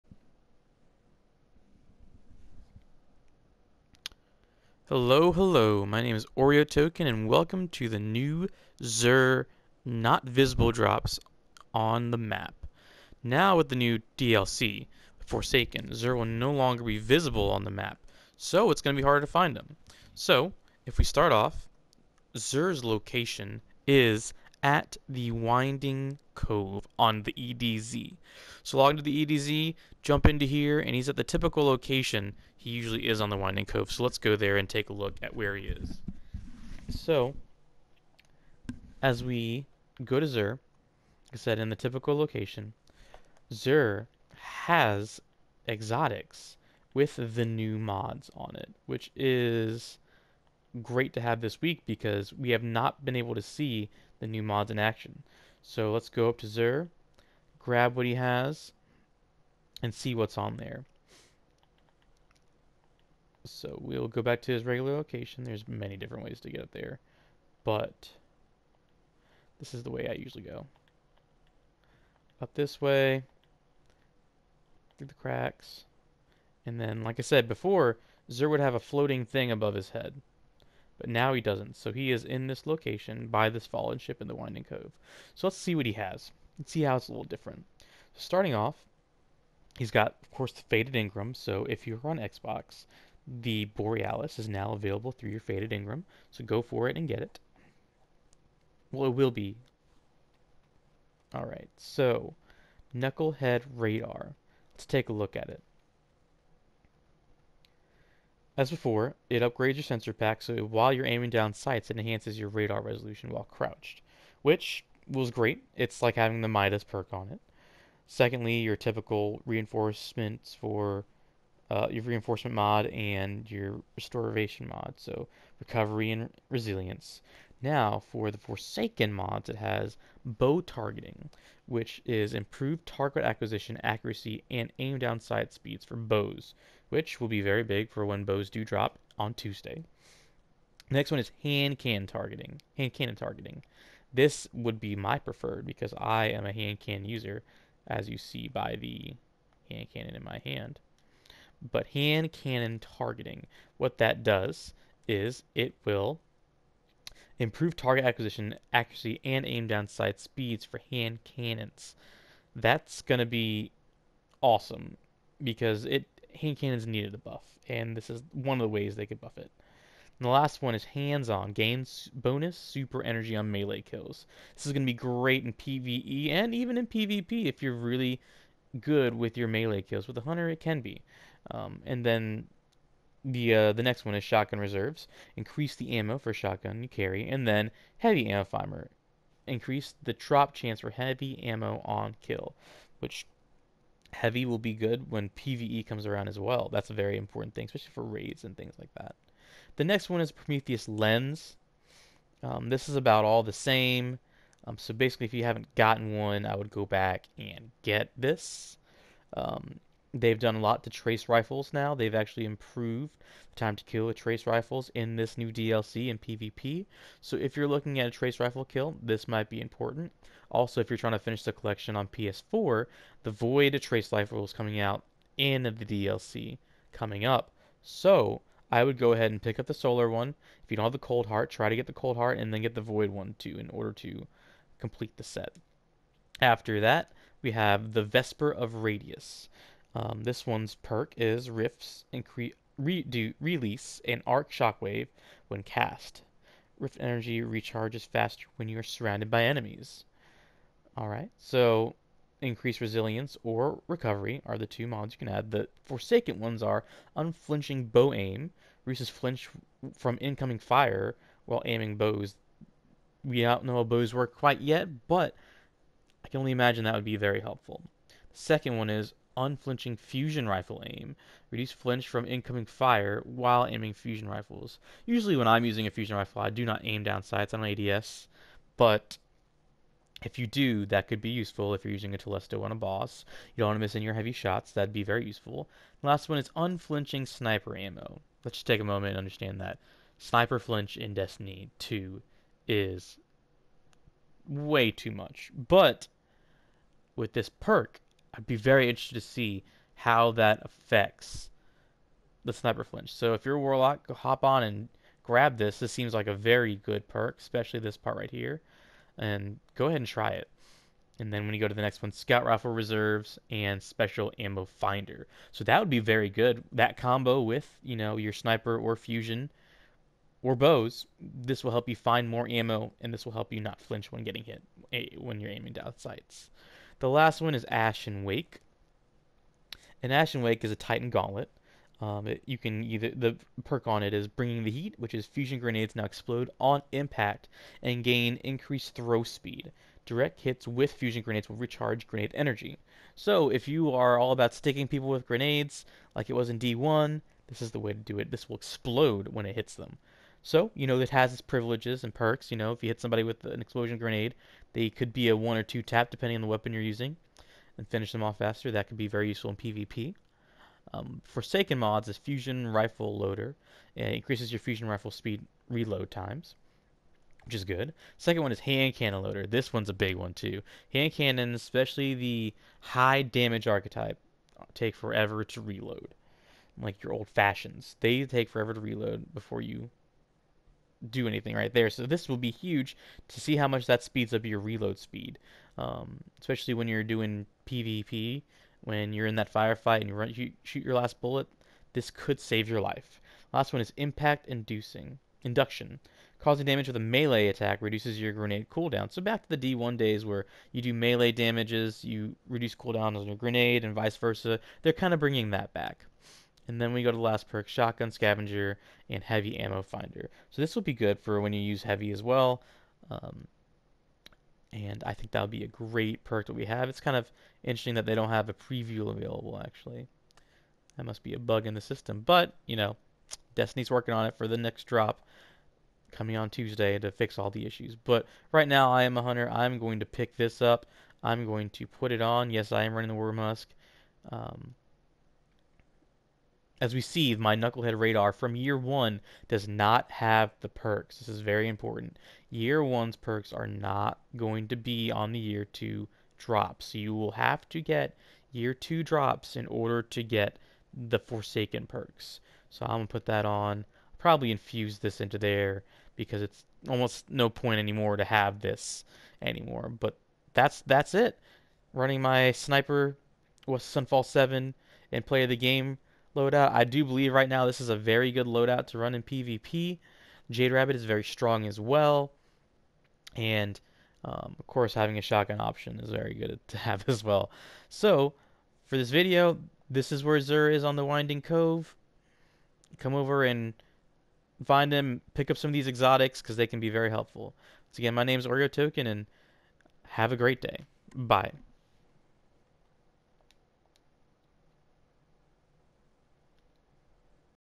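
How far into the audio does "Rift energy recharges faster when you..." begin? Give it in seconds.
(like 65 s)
246 s.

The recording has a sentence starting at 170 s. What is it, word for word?
And the last one is hands-on gains bonus super energy on melee kills.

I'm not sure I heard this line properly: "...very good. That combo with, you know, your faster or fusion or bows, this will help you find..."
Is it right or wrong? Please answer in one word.
wrong.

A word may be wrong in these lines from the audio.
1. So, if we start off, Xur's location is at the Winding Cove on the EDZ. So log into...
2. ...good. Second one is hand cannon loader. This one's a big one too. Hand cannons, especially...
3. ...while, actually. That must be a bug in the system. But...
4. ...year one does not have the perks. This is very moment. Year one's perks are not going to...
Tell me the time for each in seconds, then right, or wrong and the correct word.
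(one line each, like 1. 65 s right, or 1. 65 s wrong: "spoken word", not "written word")
1. 20 s right
2. 367 s right
3. 419 s wrong: "available", not "while"
4. 438 s wrong: "important", not "moment".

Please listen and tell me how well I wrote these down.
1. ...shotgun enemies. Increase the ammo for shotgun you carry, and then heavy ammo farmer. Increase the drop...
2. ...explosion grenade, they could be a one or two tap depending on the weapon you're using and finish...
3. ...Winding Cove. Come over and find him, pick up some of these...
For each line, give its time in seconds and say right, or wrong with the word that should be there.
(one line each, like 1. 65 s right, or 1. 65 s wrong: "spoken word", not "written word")
1. 184 s wrong: "reserves", not "enemies"
2. 353 s right
3. 481 s right.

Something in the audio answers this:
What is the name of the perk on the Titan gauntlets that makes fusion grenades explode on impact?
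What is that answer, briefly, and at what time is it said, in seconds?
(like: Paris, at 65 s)
Bringing the heat, at 334 s.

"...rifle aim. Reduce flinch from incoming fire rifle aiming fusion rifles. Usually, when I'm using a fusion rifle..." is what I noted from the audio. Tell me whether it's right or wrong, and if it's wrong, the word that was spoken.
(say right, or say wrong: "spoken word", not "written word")
wrong: "while", not "rifle".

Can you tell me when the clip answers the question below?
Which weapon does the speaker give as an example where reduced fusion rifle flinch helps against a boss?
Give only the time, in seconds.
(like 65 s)
282 s.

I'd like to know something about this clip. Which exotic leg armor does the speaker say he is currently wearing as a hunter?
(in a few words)
Wormhusk.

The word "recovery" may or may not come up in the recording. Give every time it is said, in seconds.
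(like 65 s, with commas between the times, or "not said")
125 s, 253 s.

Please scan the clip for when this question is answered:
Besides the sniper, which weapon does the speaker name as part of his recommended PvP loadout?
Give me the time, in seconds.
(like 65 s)
463 s.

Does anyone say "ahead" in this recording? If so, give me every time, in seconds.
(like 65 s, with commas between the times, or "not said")
229 s, 309 s.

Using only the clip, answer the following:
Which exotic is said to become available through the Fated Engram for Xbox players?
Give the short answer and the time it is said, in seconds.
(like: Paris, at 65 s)
Borealis, at 93 s.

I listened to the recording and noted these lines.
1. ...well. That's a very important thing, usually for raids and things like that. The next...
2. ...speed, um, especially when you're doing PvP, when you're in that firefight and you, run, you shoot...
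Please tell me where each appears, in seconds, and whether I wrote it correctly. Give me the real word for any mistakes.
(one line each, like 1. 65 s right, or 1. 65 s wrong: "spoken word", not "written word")
1. 196 s wrong: "especially", not "usually"
2. 384 s right.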